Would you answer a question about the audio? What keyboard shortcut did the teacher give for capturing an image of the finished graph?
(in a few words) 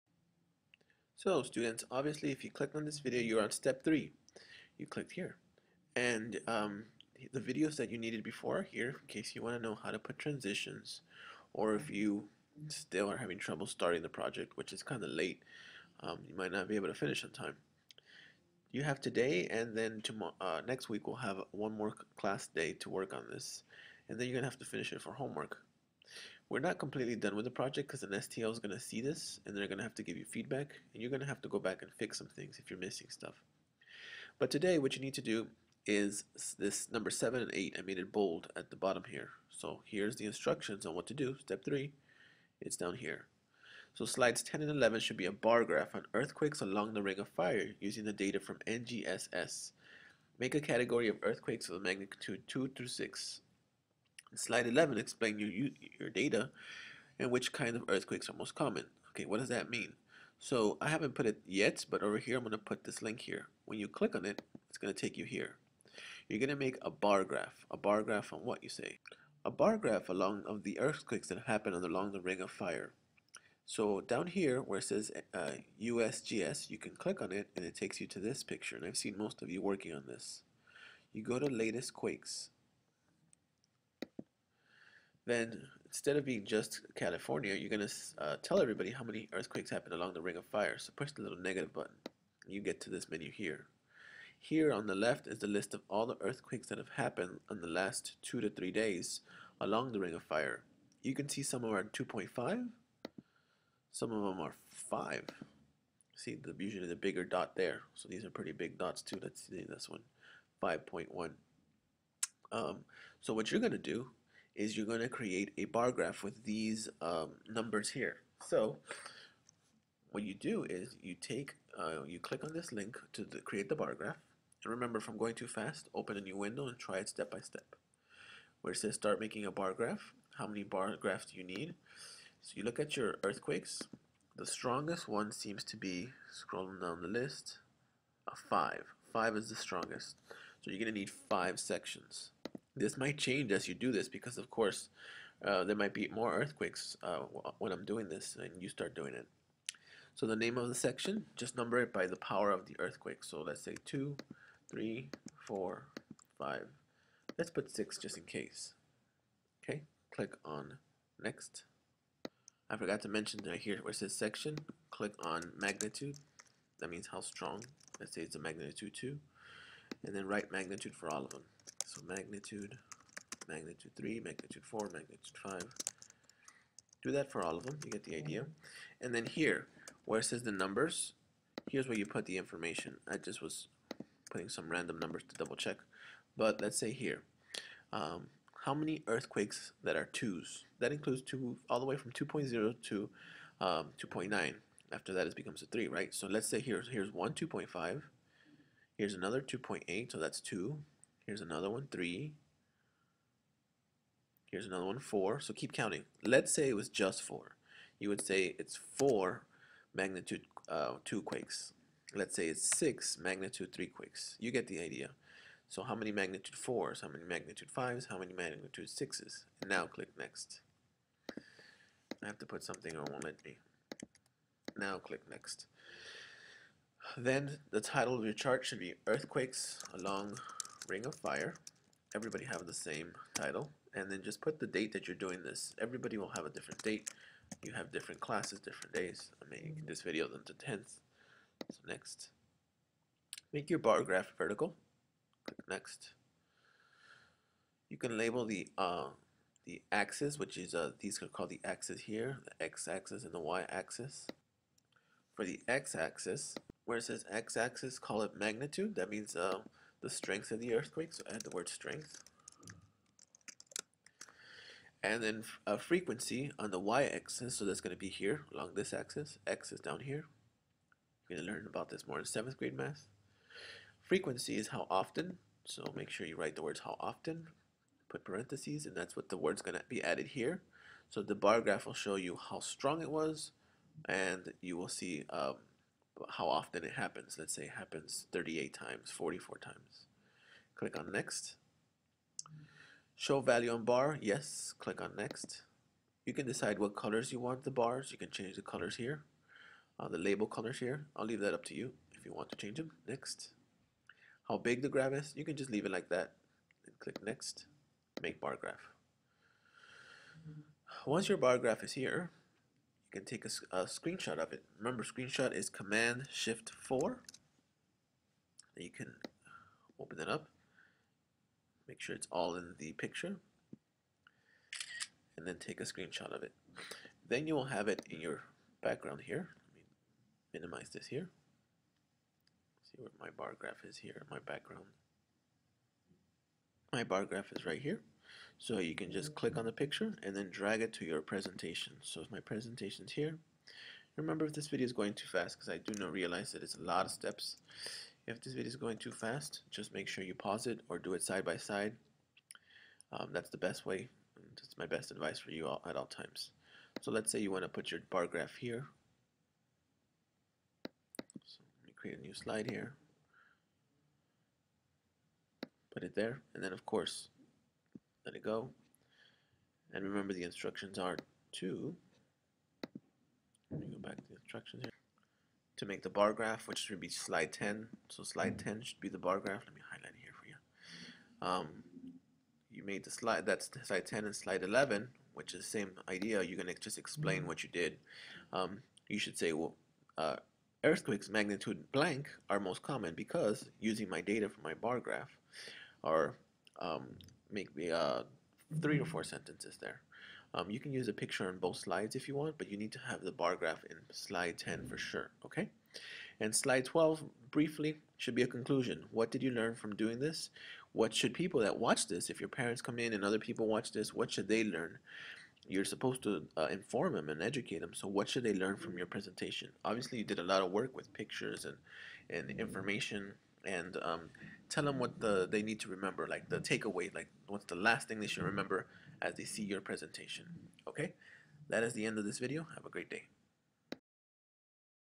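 Command Shift 4.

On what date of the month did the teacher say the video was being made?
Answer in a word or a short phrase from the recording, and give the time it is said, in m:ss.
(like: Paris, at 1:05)
10th, at 4:00.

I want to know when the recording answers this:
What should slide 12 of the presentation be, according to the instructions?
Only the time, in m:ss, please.
6:48.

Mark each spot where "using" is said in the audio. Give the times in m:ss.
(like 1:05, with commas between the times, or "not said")
0:47, 6:33.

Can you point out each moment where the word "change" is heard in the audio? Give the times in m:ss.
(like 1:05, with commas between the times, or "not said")
2:23, 4:58, 5:02.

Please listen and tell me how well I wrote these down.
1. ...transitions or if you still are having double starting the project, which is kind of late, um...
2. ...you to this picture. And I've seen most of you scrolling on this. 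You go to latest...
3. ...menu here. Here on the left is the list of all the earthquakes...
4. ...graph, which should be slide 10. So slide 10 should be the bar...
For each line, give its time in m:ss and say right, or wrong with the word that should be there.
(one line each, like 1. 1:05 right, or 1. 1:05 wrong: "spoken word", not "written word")
1. 0:10 wrong: "trouble", not "double"
2. 1:17 wrong: "working", not "scrolling"
3. 1:33 right
4. 6:16 right.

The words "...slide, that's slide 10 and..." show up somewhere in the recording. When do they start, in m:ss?
6:23.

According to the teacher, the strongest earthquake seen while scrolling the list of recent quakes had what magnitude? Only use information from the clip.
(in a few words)
5.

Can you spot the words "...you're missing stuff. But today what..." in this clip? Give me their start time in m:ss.
0:32.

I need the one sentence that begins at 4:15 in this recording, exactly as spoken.
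For the x-axis, where it says x-axis, call it magnitude.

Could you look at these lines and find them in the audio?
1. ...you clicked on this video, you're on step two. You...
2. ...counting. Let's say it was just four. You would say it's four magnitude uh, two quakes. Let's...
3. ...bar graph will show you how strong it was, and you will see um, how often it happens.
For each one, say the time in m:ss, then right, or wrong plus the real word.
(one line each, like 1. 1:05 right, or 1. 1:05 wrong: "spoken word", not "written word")
1. 0:02 wrong: "three", not "two"
2. 3:25 right
3. 4:41 right.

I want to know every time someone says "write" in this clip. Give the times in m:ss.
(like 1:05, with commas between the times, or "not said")
2:50, 4:36.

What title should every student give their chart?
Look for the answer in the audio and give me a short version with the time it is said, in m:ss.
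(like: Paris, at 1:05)
Earthquakes along Ring of Fire, at 3:49.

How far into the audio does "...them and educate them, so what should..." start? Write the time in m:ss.
6:57.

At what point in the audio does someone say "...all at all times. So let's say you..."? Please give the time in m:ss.
5:55.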